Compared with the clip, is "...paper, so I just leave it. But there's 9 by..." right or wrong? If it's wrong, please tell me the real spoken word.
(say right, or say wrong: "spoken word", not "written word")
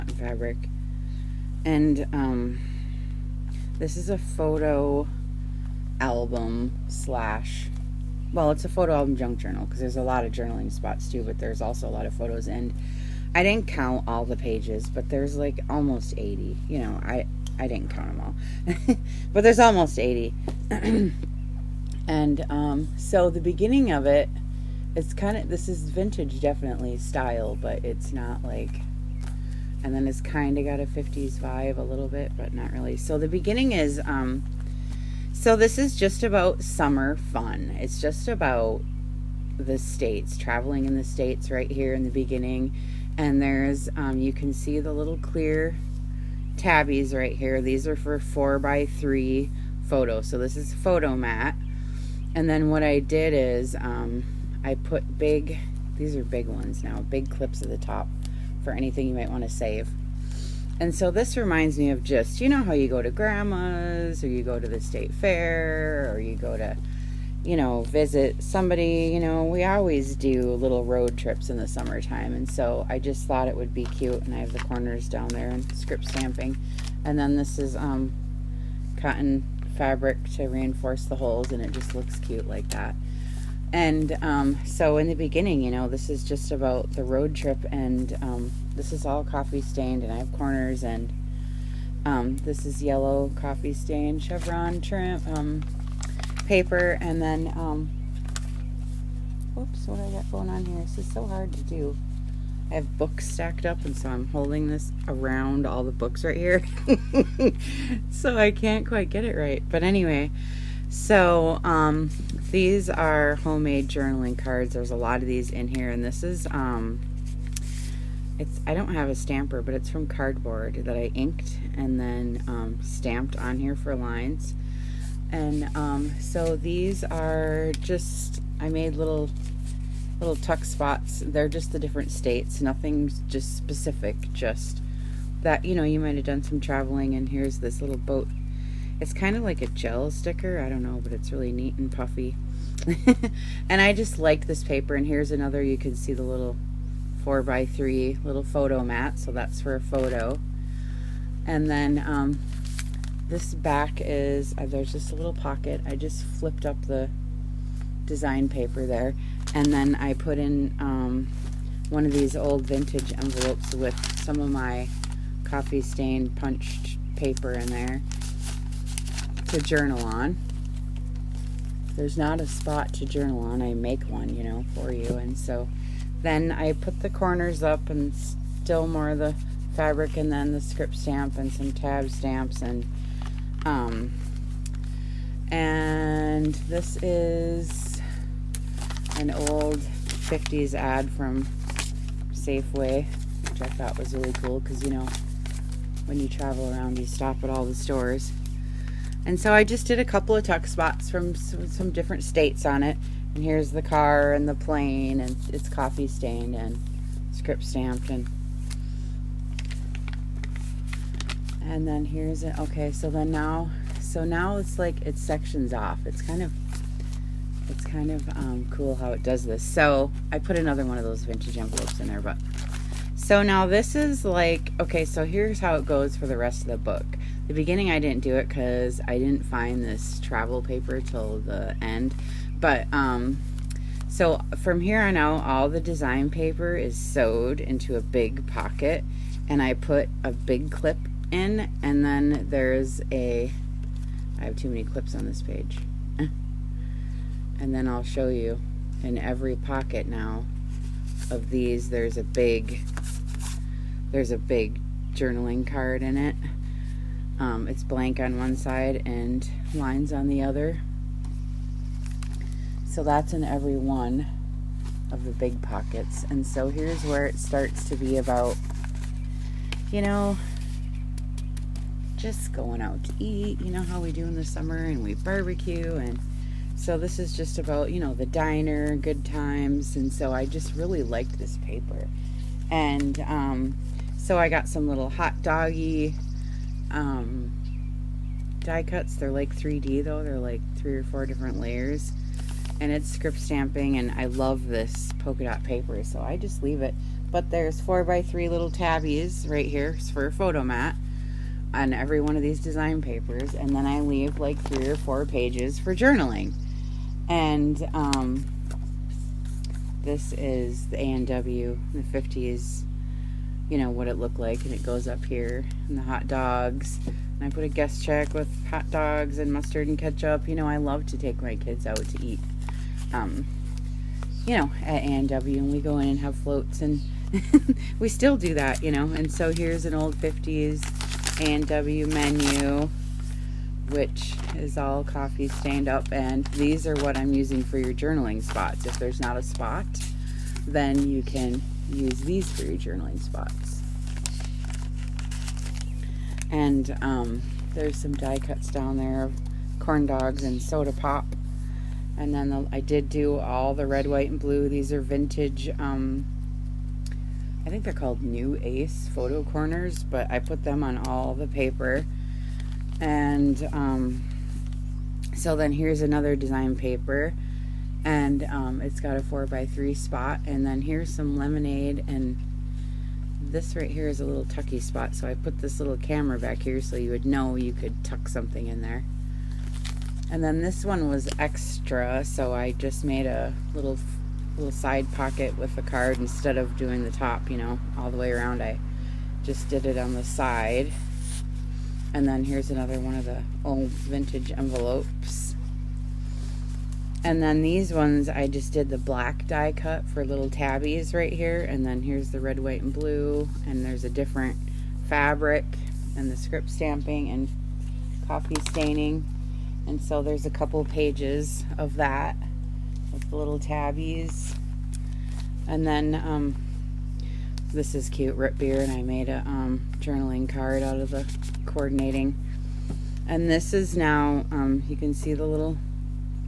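wrong: "4", not "9".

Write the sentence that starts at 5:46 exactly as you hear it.
And um, there's some die cuts down there of corn dogs and soda pop.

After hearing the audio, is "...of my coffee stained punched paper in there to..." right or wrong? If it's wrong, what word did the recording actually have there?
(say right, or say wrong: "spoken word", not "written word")
right.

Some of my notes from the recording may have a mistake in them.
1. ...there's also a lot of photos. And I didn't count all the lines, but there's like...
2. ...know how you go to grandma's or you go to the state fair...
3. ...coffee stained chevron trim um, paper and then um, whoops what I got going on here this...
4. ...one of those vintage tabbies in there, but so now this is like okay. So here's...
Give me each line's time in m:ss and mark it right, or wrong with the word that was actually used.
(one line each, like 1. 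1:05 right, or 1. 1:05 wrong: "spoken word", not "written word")
1. 0:11 wrong: "pages", not "lines"
2. 1:02 right
3. 1:33 right
4. 3:40 wrong: "envelopes", not "tabbies".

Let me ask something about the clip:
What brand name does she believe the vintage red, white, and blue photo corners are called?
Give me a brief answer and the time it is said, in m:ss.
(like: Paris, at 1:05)
Nu-Ace, at 5:58.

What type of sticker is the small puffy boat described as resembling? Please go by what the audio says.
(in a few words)
gel sticker.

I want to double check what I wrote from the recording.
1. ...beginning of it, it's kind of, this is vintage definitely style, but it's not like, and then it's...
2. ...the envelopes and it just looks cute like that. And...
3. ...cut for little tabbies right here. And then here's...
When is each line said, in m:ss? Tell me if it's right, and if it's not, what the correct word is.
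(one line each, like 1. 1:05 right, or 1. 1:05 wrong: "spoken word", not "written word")
1. 0:23 right
2. 1:21 wrong: "holes", not "envelopes"
3. 6:39 right.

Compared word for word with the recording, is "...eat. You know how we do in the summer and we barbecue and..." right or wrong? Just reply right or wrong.
right.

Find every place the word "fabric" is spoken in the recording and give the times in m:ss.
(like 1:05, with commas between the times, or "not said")
0:00, 1:19, 2:59, 6:45.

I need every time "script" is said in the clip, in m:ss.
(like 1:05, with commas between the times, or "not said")
1:15, 3:00, 3:27, 4:53, 6:46.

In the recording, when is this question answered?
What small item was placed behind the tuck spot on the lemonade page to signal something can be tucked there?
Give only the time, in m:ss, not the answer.
6:15.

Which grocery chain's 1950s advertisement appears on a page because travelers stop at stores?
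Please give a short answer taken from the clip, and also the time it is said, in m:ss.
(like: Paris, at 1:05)
Safeway, at 3:12.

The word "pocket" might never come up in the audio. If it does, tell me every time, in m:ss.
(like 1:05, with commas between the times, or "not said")
2:35, 3:58, 4:09, 4:25, 6:25.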